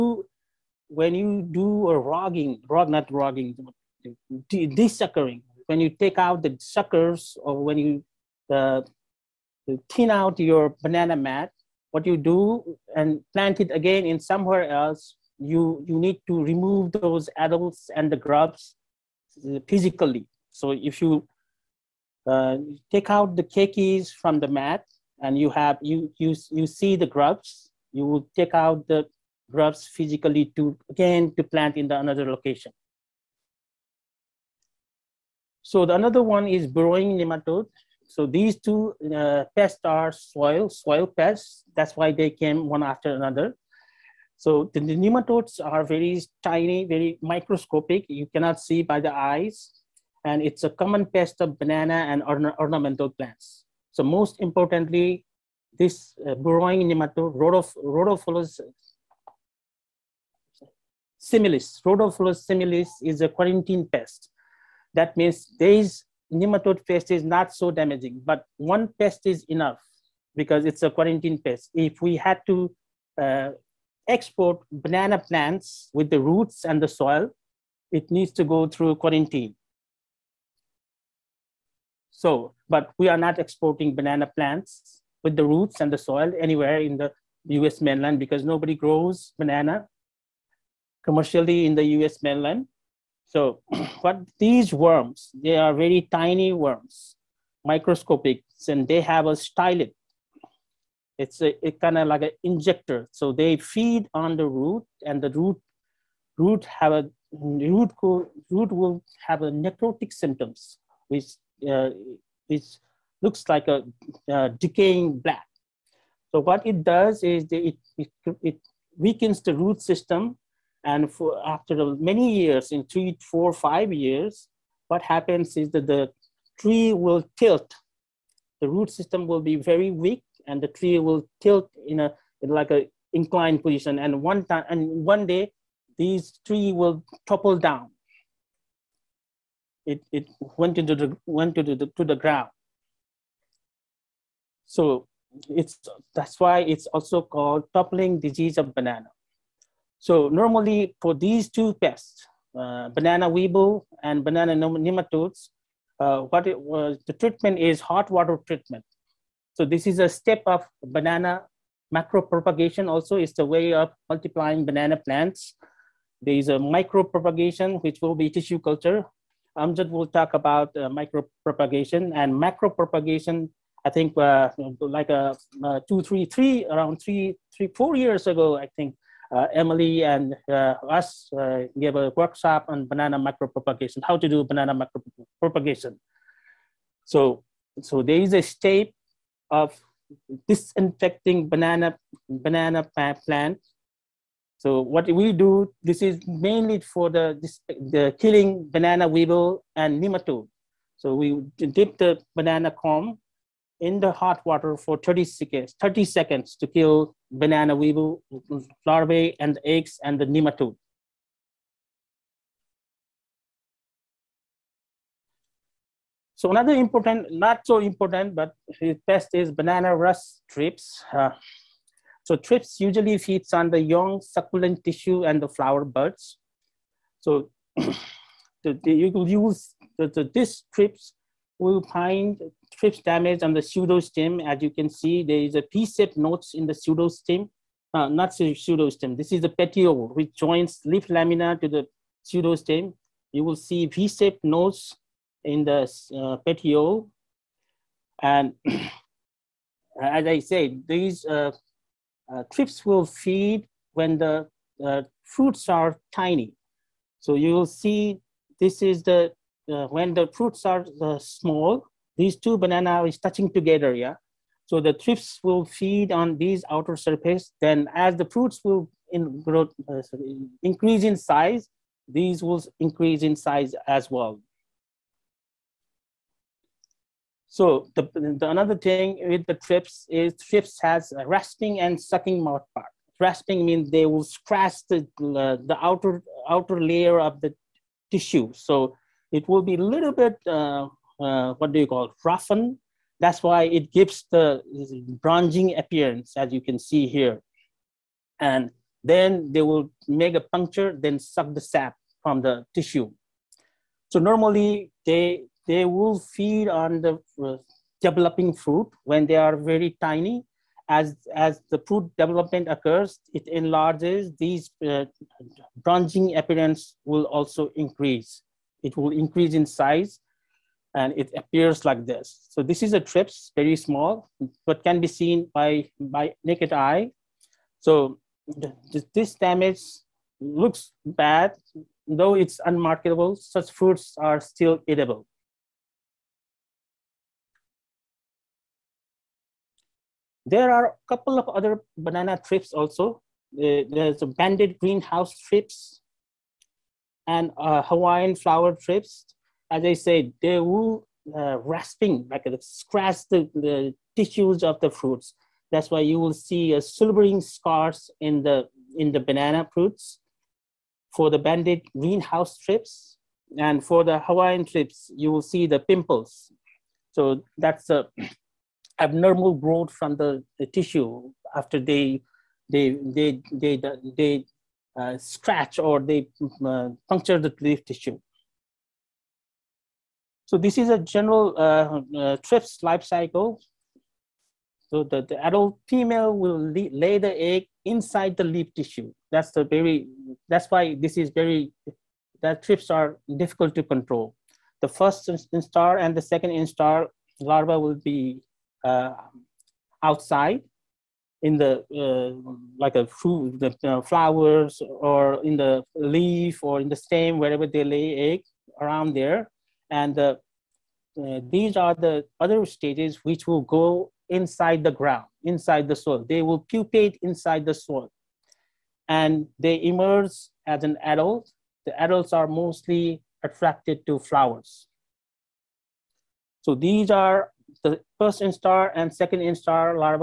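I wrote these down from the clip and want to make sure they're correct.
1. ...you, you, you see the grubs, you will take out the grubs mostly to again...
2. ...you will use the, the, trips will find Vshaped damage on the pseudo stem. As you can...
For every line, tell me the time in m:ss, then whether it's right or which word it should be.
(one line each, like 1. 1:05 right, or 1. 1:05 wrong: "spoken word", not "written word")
1. 0:25 wrong: "physically", not "mostly"
2. 3:48 wrong: "Trips", not "Vshaped".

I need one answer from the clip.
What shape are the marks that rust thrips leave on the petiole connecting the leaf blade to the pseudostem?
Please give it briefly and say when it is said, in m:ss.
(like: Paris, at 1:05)
V-shaped, at 4:03.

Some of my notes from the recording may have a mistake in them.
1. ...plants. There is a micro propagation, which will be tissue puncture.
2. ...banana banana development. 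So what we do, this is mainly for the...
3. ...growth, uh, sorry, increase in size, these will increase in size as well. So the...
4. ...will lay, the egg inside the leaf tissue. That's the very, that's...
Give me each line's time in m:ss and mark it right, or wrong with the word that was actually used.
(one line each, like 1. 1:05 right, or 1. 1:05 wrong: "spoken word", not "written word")
1. 2:44 wrong: "culture", not "puncture"
2. 3:11 wrong: "plant", not "development"
3. 4:29 right
4. 6:26 right.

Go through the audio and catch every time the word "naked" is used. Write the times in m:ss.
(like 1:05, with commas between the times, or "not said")
5:26.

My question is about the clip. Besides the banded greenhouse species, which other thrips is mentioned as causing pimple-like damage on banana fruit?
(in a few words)
Hawaiian flower thrips.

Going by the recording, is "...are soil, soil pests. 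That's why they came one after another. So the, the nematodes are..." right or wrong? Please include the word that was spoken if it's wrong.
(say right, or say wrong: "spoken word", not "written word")
right.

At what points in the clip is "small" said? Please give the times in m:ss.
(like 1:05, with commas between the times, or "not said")
4:21, 5:23.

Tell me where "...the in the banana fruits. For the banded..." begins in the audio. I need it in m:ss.
5:58.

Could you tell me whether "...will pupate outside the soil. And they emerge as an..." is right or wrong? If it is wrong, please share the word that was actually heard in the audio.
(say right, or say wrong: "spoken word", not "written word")
wrong: "inside", not "outside".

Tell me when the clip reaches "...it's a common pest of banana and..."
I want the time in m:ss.
0:50.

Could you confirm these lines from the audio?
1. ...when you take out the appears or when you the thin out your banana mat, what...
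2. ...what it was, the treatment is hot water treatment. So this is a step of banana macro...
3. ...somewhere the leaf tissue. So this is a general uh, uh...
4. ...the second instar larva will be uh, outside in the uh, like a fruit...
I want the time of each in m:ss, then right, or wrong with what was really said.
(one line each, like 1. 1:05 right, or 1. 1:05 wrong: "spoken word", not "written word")
1. 0:05 wrong: "suckers", not "appears"
2. 2:36 right
3. 6:17 wrong: "puncture", not "somewhere"
4. 6:36 right.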